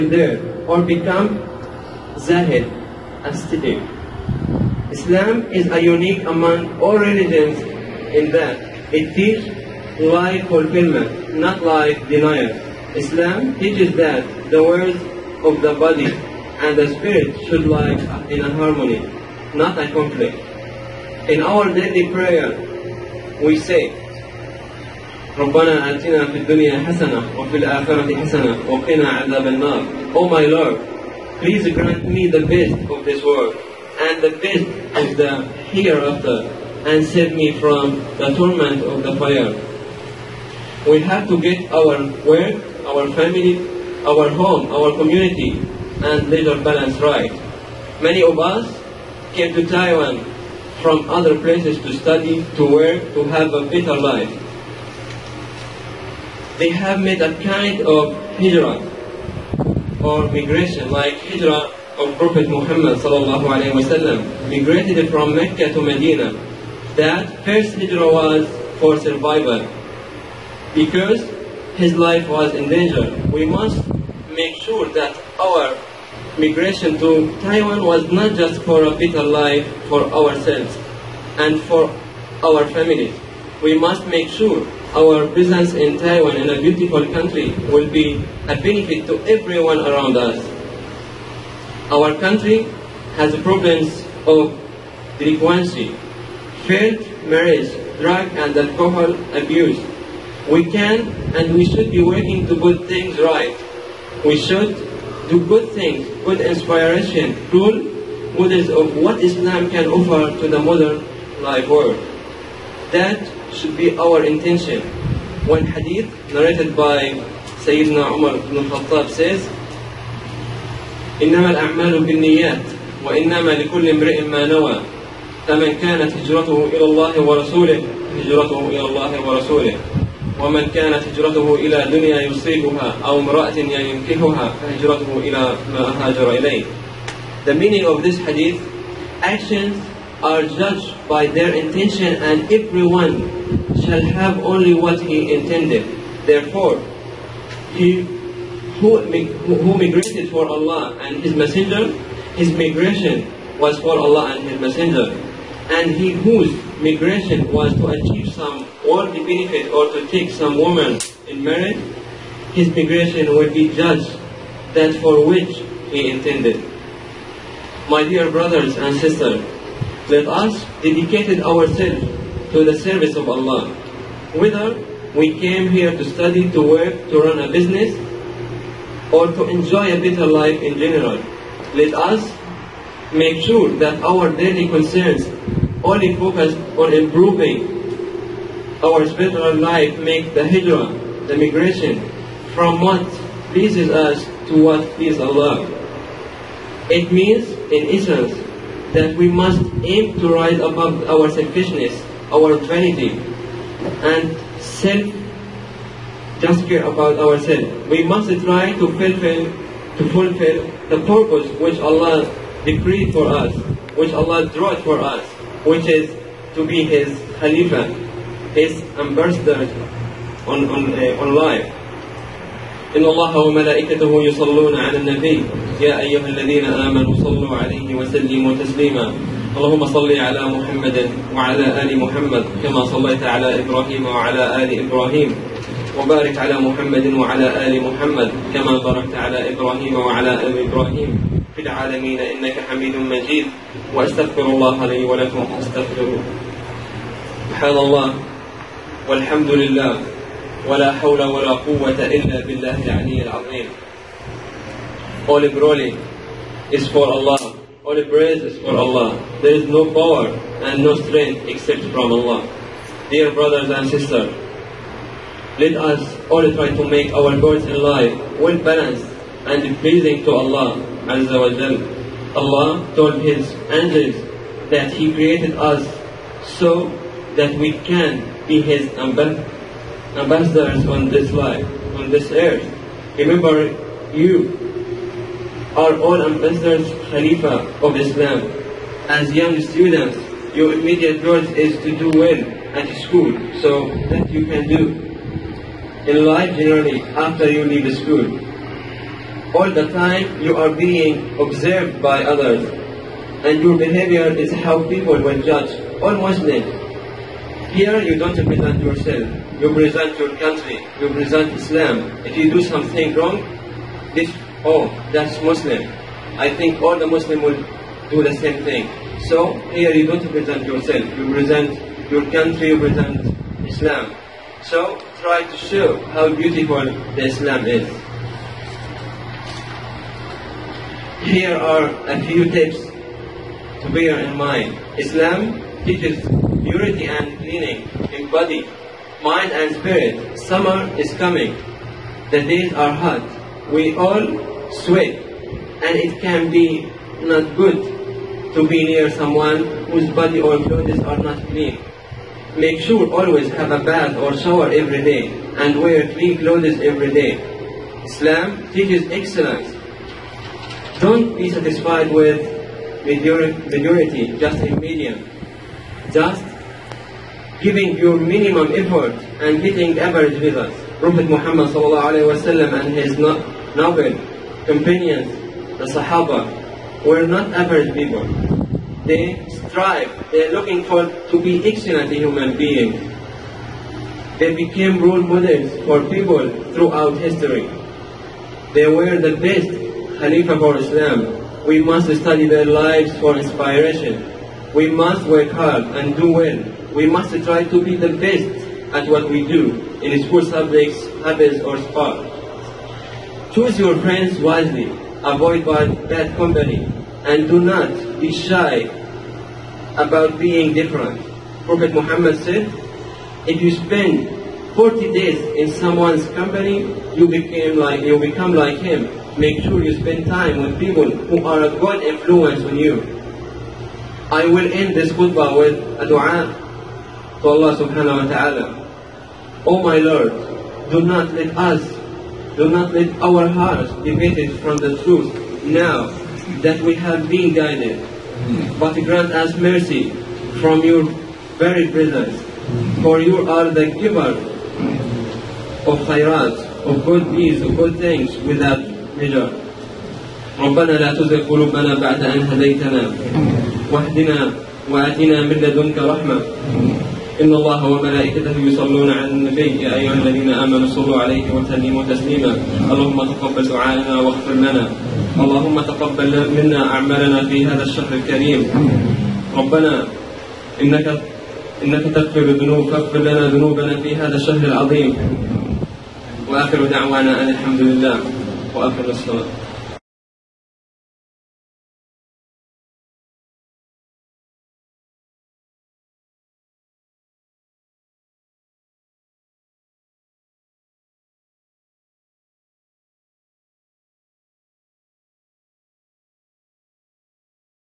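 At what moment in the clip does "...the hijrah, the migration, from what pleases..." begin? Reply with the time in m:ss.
3:10.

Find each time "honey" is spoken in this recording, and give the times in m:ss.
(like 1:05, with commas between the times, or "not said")
not said.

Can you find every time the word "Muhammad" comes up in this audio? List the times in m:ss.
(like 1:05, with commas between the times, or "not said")
1:02, 6:11, 6:51.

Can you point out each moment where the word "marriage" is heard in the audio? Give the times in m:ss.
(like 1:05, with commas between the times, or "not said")
1:37, 2:41.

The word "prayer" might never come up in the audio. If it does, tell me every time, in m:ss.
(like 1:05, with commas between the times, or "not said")
0:22.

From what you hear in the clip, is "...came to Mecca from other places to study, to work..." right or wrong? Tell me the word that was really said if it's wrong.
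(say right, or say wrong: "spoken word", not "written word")
wrong: "Taiwan", not "Mecca".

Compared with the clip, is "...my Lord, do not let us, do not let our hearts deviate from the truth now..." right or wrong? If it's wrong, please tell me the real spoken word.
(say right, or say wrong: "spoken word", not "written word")
right.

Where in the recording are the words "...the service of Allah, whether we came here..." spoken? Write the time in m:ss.
2:52.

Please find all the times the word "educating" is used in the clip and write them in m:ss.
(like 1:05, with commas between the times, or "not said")
not said.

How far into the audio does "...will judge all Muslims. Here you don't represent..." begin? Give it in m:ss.
5:05.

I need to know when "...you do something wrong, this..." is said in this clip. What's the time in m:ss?
5:12.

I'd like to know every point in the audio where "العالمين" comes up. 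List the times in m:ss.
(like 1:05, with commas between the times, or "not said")
4:01.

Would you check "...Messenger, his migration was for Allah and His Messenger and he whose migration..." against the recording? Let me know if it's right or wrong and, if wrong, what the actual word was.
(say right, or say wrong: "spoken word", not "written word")
right.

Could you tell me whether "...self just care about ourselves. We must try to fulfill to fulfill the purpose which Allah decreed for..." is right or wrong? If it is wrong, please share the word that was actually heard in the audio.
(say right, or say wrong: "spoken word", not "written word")
right.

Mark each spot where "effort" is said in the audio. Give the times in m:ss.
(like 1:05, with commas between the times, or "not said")
6:08.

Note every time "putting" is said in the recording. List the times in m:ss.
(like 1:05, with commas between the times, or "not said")
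not said.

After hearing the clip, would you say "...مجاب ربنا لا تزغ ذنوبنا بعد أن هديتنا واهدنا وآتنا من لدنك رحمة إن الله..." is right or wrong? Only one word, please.
wrong.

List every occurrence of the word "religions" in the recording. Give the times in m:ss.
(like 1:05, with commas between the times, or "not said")
0:06.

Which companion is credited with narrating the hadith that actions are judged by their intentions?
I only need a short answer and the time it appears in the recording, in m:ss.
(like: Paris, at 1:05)
Umar ibn Khattab, at 1:57.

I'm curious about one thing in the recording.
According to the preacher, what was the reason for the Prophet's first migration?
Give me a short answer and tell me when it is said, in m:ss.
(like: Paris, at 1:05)
Survival, at 1:08.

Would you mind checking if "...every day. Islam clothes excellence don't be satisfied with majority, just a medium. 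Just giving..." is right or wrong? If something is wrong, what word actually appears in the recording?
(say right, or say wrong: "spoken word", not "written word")
wrong: "teaches", not "clothes".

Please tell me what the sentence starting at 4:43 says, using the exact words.
Remember, you are all ambassadors, Khalifa of Islam.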